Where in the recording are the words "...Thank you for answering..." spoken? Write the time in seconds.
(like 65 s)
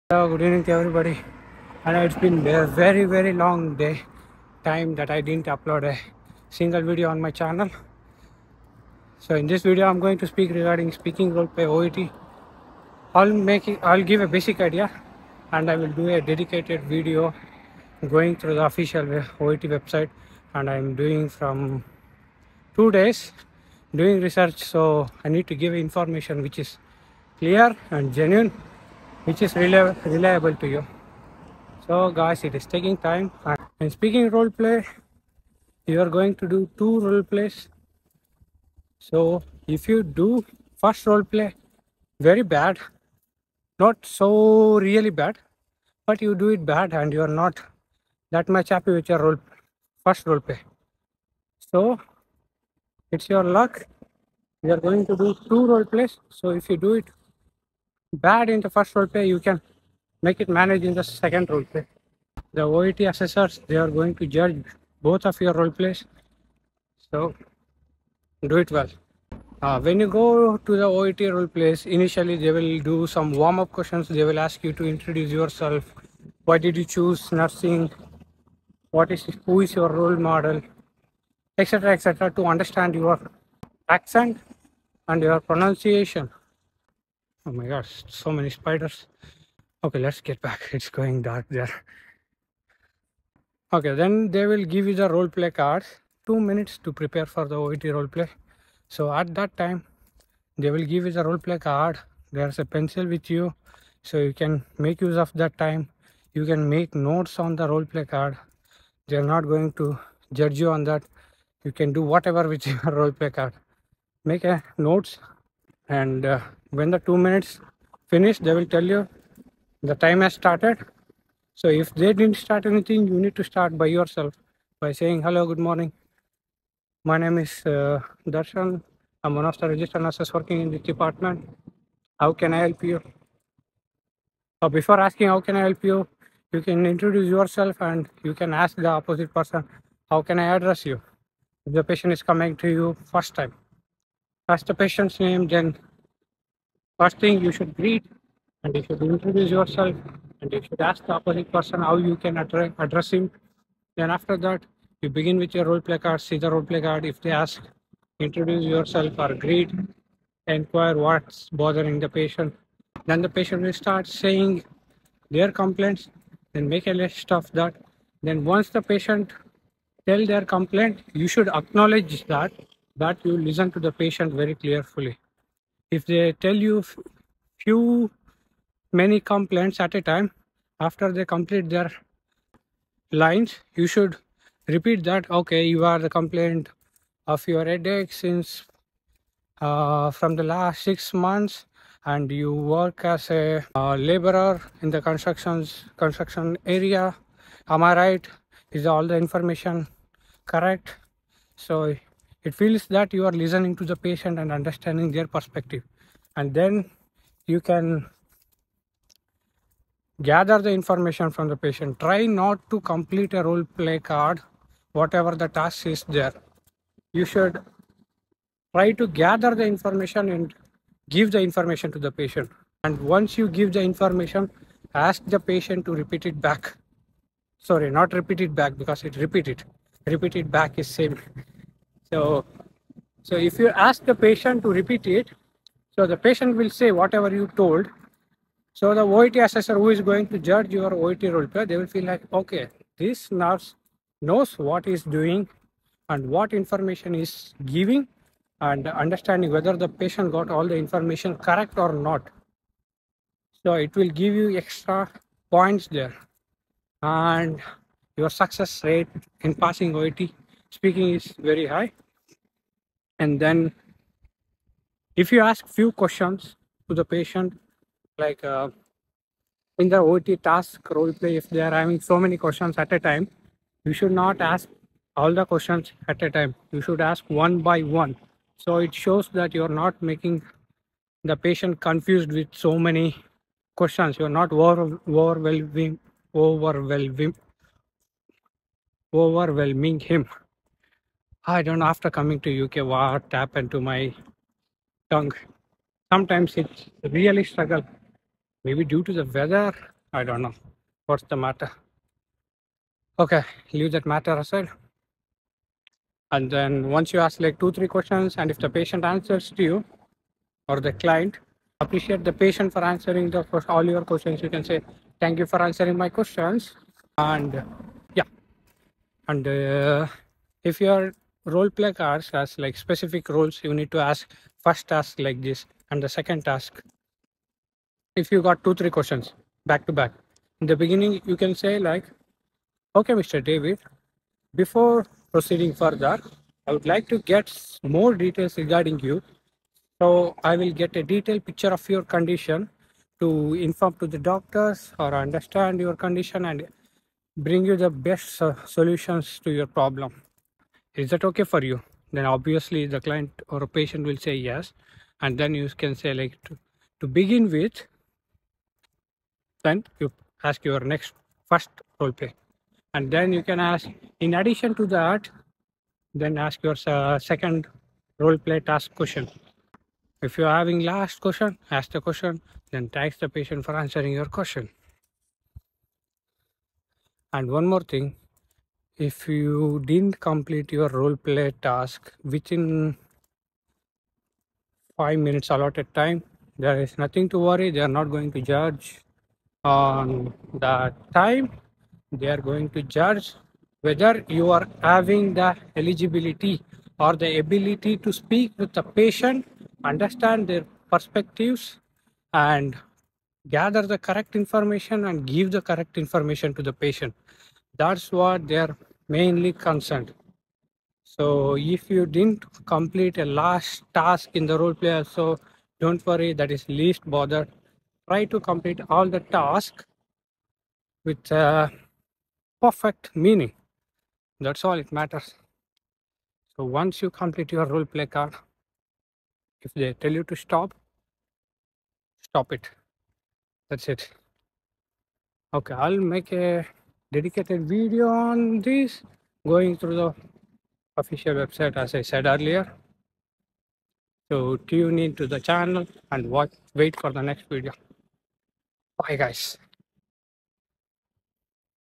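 315 s.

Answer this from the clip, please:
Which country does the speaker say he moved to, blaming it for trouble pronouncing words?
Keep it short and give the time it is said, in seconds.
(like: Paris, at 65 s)
UK, at 292 s.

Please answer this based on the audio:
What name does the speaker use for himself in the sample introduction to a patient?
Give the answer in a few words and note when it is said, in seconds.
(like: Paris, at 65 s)
Darshan, at 128 s.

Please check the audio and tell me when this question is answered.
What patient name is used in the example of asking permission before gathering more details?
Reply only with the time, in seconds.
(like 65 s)
333 s.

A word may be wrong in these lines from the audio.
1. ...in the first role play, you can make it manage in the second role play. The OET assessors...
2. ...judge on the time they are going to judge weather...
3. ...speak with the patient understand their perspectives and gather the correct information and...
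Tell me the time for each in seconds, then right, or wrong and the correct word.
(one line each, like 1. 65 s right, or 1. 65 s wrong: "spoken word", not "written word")
1. 58 s right
2. 388 s wrong: "whether", not "weather"
3. 398 s right.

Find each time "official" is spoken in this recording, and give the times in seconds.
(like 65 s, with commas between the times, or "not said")
18 s, 440 s.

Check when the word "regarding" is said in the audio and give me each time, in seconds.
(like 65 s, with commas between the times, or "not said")
10 s, 338 s.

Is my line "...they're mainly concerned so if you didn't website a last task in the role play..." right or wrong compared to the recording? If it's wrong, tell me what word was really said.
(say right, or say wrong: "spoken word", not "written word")
wrong: "complete", not "website".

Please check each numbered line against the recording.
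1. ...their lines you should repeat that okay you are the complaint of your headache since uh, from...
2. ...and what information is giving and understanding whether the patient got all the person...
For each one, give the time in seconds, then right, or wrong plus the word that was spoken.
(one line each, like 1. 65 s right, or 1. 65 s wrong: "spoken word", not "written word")
1. 181 s right
2. 246 s wrong: "information", not "person".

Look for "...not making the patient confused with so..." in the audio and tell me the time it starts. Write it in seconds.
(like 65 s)
279 s.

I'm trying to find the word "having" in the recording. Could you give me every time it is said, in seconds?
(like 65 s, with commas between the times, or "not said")
271 s, 370 s, 394 s.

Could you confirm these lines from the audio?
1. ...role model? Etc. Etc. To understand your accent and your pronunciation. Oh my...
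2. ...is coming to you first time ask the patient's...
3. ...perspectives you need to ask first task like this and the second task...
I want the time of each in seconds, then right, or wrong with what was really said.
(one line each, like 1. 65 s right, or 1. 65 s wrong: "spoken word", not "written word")
1. 79 s right
2. 142 s right
3. 323 s wrong: "rules", not "perspectives".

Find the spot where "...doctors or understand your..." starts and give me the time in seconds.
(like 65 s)
344 s.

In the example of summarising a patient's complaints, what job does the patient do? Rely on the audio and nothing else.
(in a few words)
Laborer.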